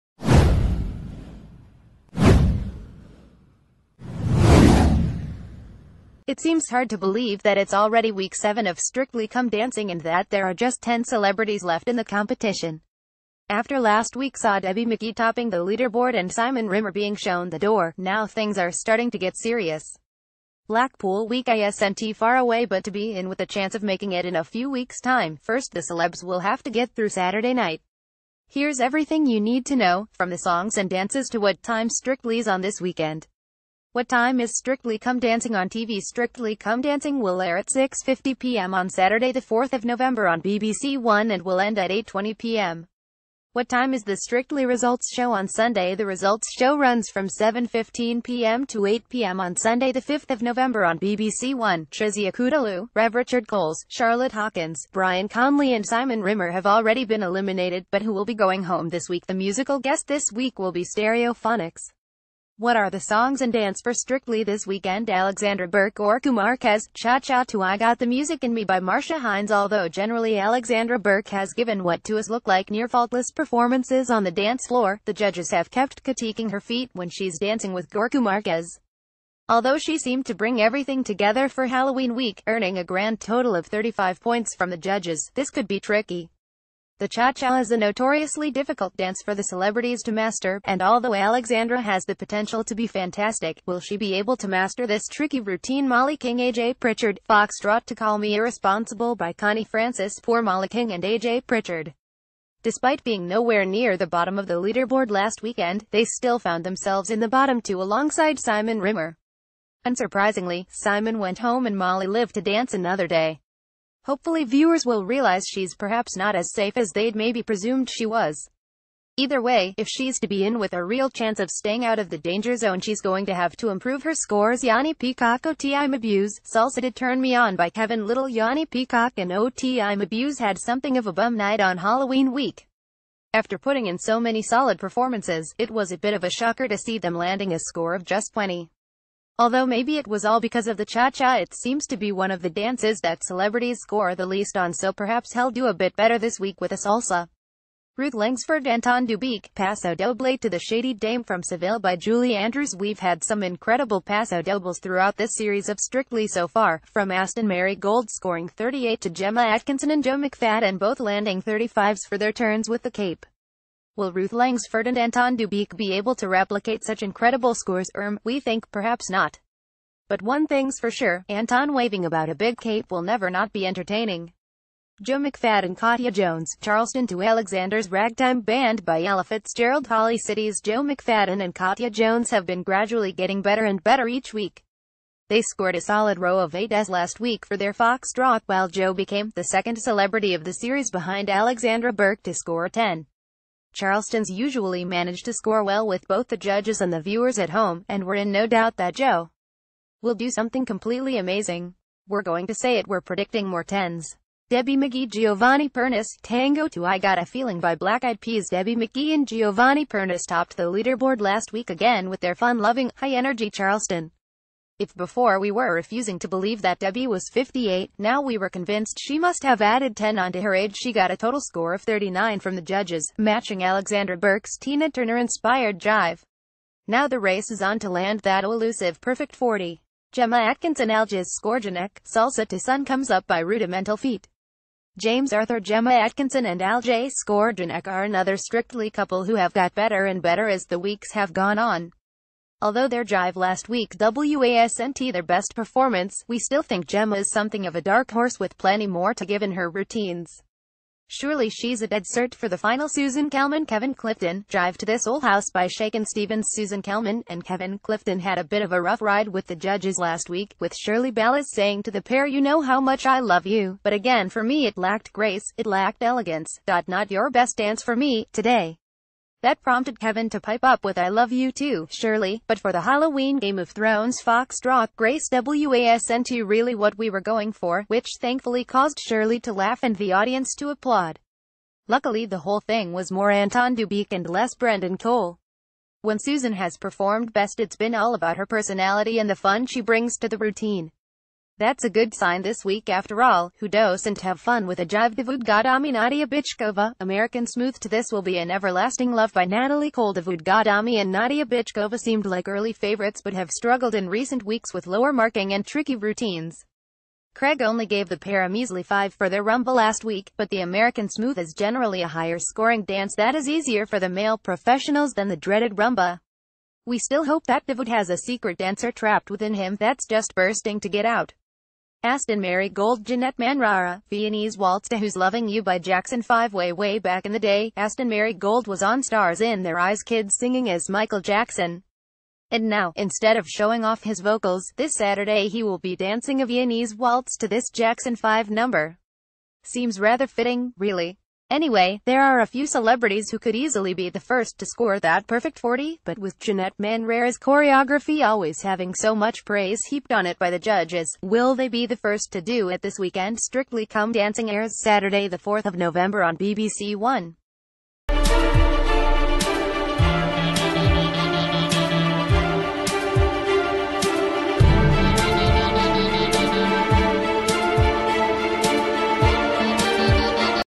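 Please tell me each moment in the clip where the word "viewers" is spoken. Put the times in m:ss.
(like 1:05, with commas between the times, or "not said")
1:54, 3:16.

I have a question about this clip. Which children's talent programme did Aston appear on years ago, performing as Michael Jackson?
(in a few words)
Stars in Their Eyes Kids.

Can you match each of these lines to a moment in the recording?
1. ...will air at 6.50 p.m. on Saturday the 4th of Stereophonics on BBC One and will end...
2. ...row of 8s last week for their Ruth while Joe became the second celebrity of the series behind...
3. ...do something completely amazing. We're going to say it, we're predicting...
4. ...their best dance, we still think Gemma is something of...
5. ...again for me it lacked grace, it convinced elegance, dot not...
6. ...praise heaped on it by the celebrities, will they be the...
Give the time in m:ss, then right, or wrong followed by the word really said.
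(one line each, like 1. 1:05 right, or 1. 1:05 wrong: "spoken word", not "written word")
1. 0:37 wrong: "November", not "Stereophonics"
2. 3:06 wrong: "Foxtrot", not "Ruth"
3. 3:20 right
4. 4:05 wrong: "performance", not "dance"
5. 4:23 wrong: "lacked", not "convinced"
6. 5:49 wrong: "judges", not "celebrities".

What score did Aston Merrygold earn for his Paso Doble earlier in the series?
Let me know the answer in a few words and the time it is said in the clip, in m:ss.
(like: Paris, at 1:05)
38, at 2:38.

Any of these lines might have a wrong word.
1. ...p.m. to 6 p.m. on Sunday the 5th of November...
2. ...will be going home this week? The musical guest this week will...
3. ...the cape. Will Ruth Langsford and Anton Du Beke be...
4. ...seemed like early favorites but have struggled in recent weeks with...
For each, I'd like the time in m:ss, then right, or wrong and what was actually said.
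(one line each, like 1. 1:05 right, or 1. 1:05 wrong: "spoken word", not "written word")
1. 0:48 wrong: "8", not "6"
2. 0:58 right
3. 2:42 right
4. 5:01 right.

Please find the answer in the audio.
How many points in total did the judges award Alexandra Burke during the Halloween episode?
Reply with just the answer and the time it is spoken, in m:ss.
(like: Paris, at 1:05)
35, at 1:23.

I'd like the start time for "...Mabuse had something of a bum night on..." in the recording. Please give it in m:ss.
2:09.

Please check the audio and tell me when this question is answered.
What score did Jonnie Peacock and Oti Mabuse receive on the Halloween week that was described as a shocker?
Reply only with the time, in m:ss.
2:17.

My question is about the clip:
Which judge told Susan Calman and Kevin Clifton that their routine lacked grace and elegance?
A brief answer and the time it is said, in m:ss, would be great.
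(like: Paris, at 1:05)
Shirley Ballas, at 4:20.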